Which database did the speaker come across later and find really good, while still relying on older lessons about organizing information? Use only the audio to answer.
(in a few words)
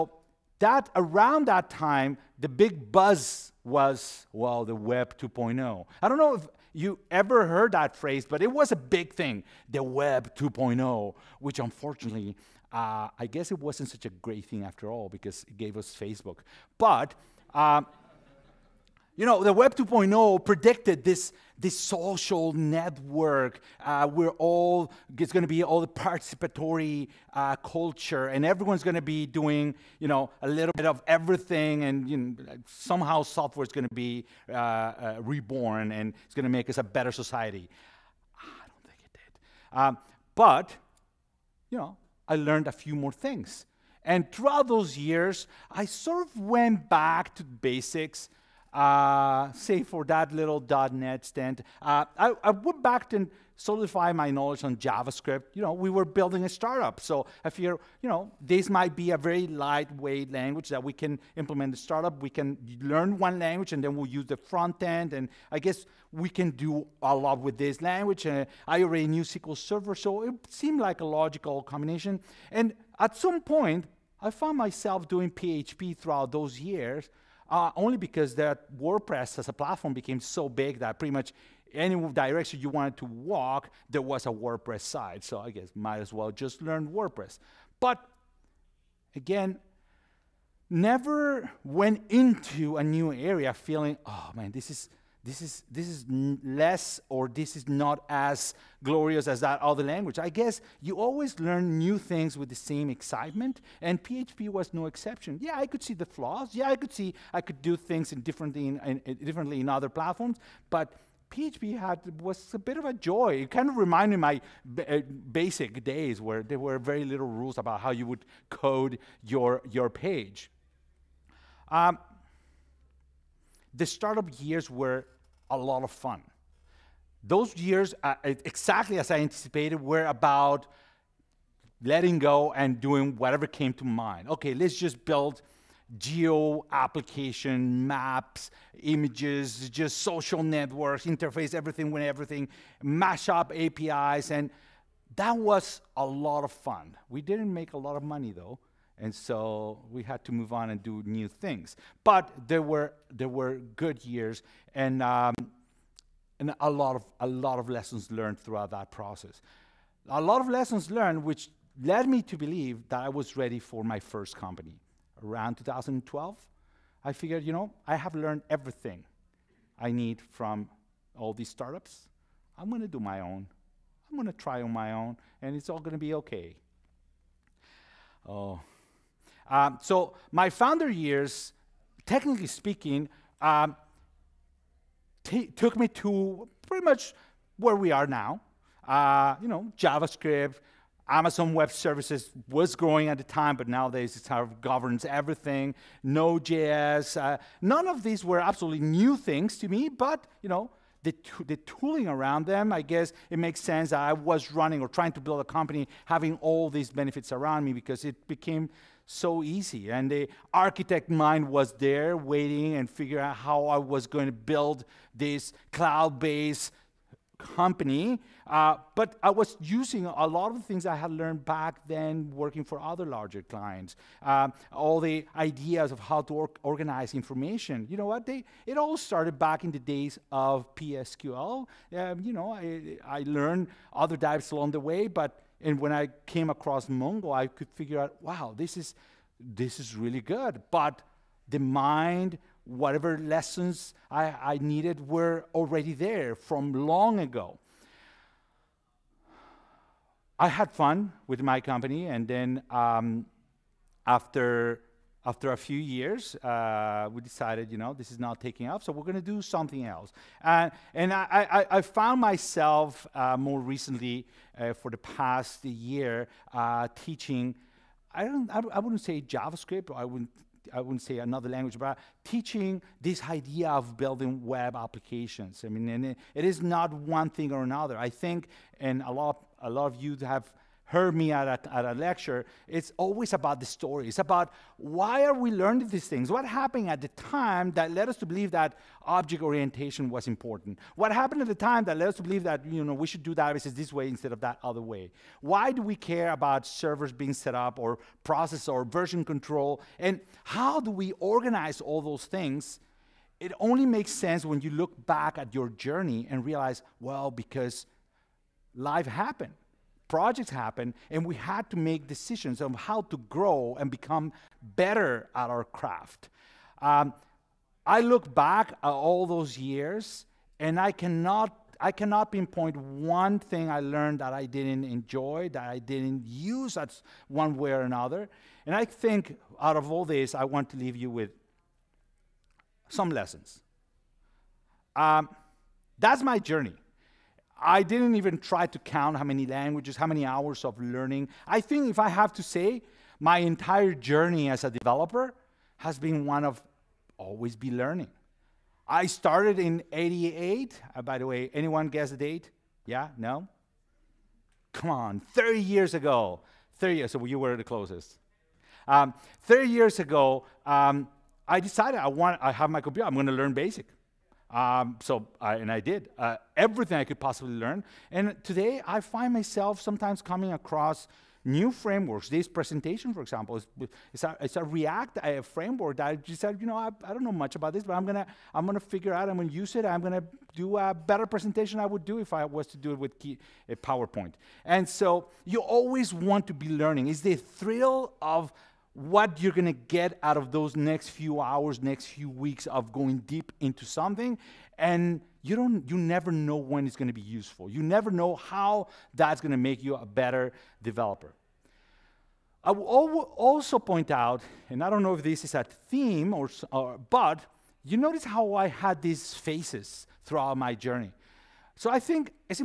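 Mongo.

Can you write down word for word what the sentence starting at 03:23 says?
I was running or trying to build a company having all these benefits around me because it became so easy.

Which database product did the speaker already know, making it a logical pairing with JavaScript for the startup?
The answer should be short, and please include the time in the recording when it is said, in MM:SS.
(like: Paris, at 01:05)
SQL Server, at 01:09.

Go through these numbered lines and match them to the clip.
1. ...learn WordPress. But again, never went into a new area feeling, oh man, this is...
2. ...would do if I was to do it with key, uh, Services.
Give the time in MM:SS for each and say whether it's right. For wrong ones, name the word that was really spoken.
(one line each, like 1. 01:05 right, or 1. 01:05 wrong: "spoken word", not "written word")
1. 01:26 right
2. 06:21 wrong: "PowerPoint", not "Services".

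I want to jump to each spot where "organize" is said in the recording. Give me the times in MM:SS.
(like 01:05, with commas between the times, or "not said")
03:46, 05:01.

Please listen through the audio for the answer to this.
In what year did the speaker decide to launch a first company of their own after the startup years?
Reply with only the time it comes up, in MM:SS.
02:45.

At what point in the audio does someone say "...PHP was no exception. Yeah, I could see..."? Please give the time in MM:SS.
01:44.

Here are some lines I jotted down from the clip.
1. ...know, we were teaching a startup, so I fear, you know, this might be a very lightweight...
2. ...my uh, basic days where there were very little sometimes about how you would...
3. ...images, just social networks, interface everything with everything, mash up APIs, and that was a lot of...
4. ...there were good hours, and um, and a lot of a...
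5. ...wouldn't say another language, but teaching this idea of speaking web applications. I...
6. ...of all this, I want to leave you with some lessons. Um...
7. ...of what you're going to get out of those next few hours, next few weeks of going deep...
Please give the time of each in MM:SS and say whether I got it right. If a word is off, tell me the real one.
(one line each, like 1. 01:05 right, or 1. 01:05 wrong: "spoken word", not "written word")
1. 00:55 wrong: "building", not "teaching"
2. 01:54 wrong: "rules", not "sometimes"
3. 02:18 right
4. 02:33 wrong: "years", not "hours"
5. 04:30 wrong: "building", not "speaking"
6. 05:29 right
7. 06:28 right.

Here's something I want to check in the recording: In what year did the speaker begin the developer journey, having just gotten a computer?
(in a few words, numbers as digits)
1988.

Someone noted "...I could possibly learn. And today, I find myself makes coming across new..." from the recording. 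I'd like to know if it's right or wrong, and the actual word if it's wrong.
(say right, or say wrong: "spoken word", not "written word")
wrong: "sometimes", not "makes".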